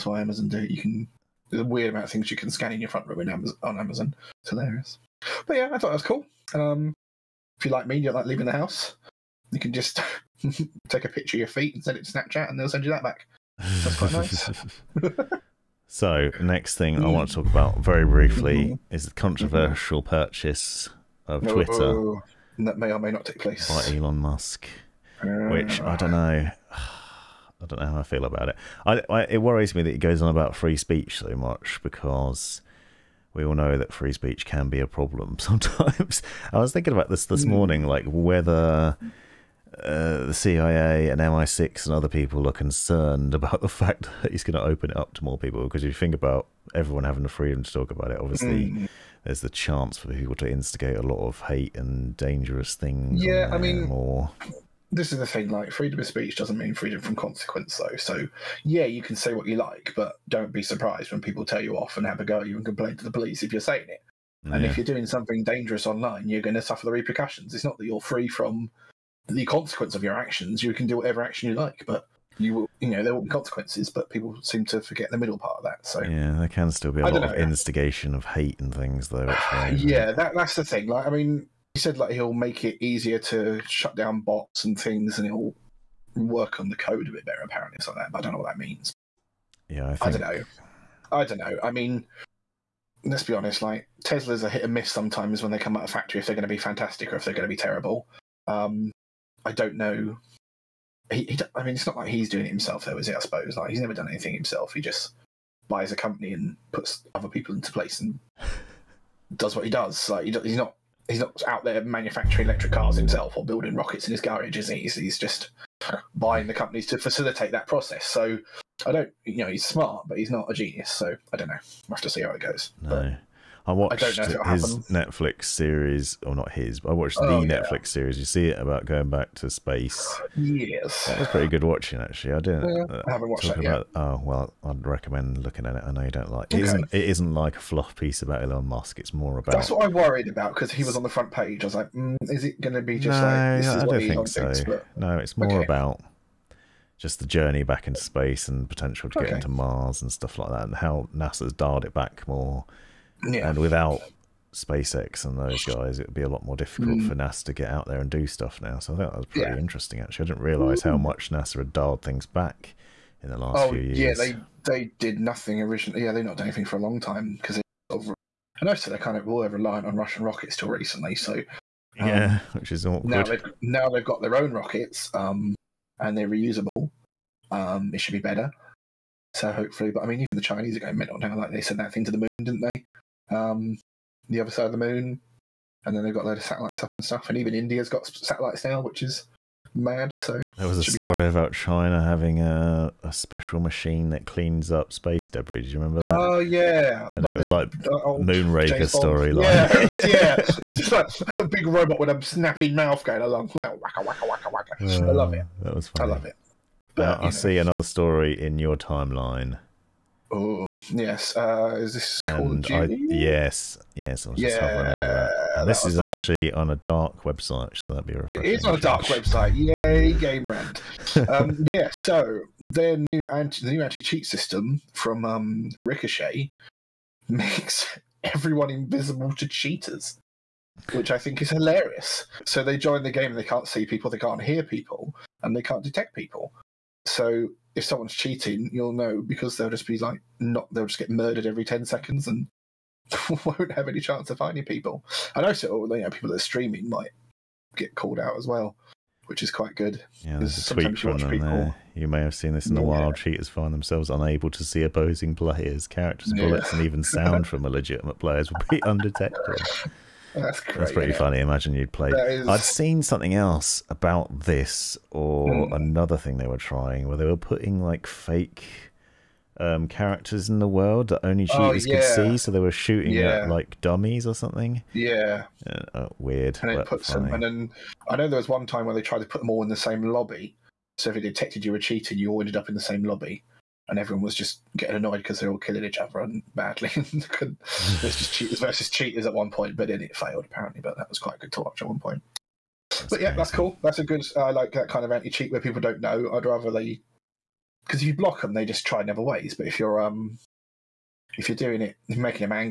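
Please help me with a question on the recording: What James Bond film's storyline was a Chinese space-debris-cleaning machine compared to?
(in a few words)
Moonraker.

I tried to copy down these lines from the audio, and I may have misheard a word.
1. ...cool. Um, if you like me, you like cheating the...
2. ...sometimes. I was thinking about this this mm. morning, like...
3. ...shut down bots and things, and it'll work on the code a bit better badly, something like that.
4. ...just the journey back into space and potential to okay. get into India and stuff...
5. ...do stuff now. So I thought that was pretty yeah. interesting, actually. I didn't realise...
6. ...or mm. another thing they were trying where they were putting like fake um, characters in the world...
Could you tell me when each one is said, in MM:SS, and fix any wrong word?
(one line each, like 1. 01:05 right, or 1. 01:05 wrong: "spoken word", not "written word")
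1. 00:06 wrong: "leaving", not "cheating"
2. 00:35 right
3. 01:23 wrong: "apparently", not "badly"
4. 02:26 wrong: "Mars", not "India"
5. 02:38 right
6. 04:25 right.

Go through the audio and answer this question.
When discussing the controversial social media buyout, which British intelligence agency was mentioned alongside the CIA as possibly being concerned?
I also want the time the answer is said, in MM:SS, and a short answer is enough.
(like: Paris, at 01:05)
MI6, at 00:41.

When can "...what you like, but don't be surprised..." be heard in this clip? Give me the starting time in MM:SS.
00:59.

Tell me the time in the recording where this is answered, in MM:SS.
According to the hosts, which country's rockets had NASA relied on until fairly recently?
02:49.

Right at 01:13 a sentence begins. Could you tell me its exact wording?
But people seem to forget the middle part of that.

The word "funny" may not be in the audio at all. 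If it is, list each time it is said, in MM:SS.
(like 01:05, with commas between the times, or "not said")
03:25, 04:21.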